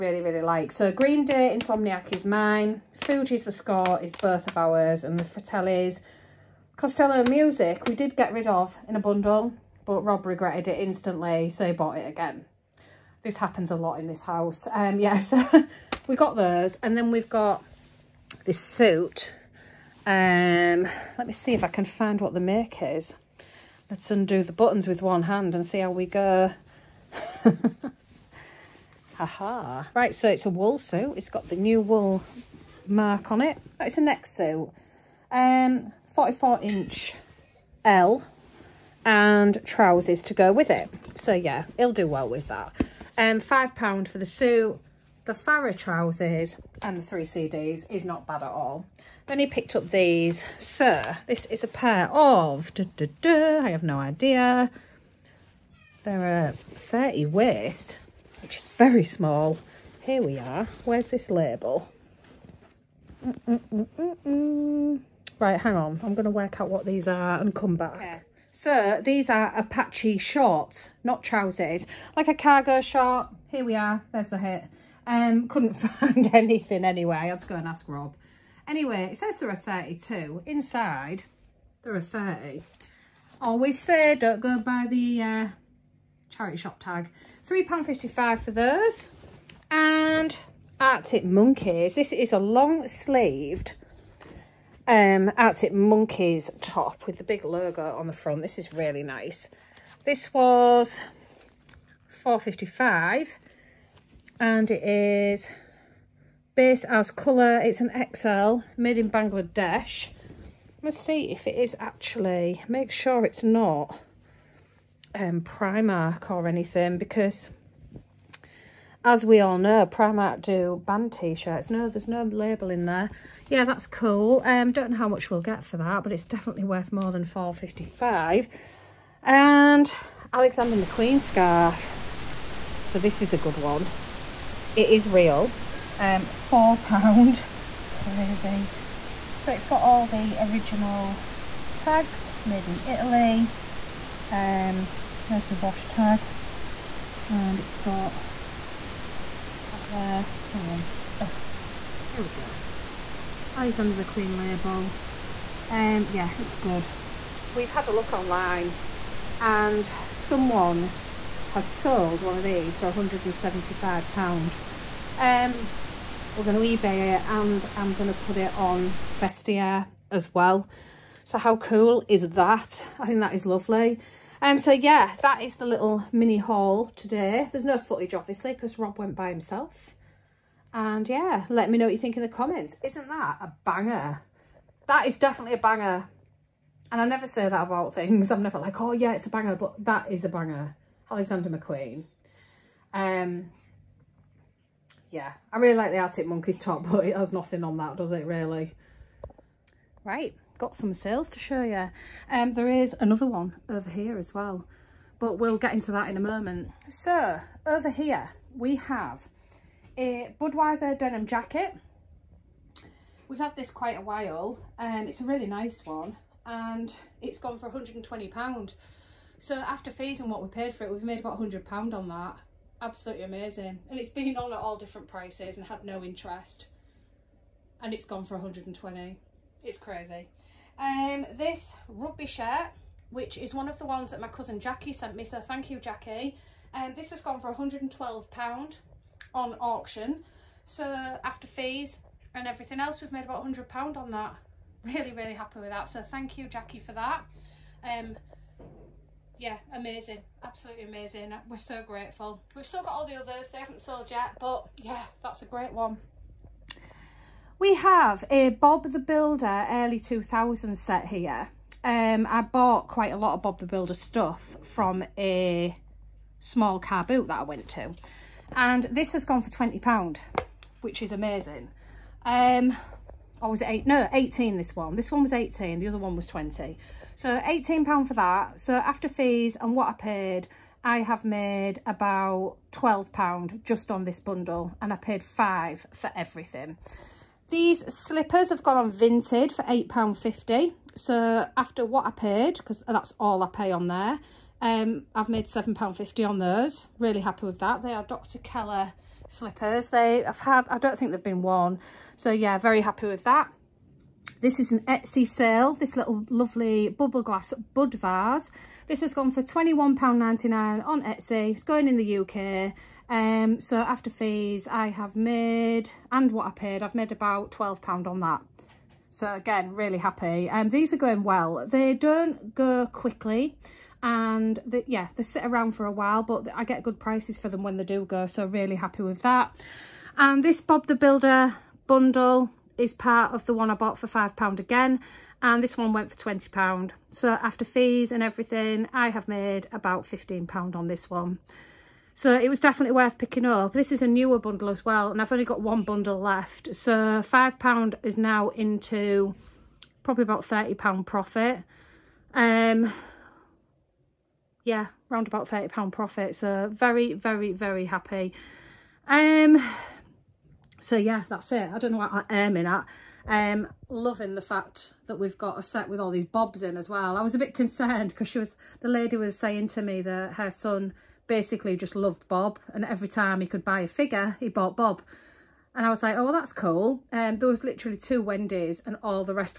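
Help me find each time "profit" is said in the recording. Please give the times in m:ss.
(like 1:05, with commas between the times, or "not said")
5:51, 5:55.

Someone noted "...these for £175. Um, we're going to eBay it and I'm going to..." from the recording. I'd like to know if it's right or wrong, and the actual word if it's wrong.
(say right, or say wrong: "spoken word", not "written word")
right.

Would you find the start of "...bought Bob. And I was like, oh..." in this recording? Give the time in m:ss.
6:14.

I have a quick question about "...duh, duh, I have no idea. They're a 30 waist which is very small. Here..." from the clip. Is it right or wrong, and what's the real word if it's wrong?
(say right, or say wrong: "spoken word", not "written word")
right.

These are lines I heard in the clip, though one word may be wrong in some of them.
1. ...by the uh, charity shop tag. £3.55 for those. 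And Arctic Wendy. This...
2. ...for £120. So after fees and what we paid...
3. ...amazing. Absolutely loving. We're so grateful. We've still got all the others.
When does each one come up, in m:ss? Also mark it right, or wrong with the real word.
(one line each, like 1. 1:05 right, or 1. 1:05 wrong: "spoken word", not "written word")
1. 1:24 wrong: "Monkeys", not "Wendy"
2. 3:37 right
3. 4:09 wrong: "amazing", not "loving".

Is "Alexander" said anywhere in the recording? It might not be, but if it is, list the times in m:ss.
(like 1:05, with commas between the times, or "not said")
2:10, 2:33, 3:11.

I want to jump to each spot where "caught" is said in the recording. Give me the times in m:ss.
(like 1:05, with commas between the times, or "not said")
not said.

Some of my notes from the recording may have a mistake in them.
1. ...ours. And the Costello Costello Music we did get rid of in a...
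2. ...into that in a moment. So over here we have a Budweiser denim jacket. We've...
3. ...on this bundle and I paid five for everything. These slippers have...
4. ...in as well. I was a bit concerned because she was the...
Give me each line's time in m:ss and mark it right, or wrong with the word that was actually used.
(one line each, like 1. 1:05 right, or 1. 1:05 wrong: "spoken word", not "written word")
1. 0:04 wrong: "Fratellis", not "Costello"
2. 3:25 right
3. 4:43 right
4. 6:06 right.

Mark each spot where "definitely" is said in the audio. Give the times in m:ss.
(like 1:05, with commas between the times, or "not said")
2:06, 3:05, 5:42.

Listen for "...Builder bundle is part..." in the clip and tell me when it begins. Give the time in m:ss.
5:30.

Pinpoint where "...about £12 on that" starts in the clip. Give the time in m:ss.
5:17.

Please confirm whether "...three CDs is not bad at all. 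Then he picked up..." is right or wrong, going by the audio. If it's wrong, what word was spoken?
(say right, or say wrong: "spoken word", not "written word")
right.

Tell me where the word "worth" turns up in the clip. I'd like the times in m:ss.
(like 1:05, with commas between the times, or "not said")
2:06, 5:42.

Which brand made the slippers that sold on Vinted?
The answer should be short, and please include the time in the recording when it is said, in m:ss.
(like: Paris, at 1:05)
Dr. Keller, at 4:58.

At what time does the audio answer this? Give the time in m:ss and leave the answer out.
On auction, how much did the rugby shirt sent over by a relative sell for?
3:57.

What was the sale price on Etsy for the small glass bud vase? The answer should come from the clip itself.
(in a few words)
£21.99.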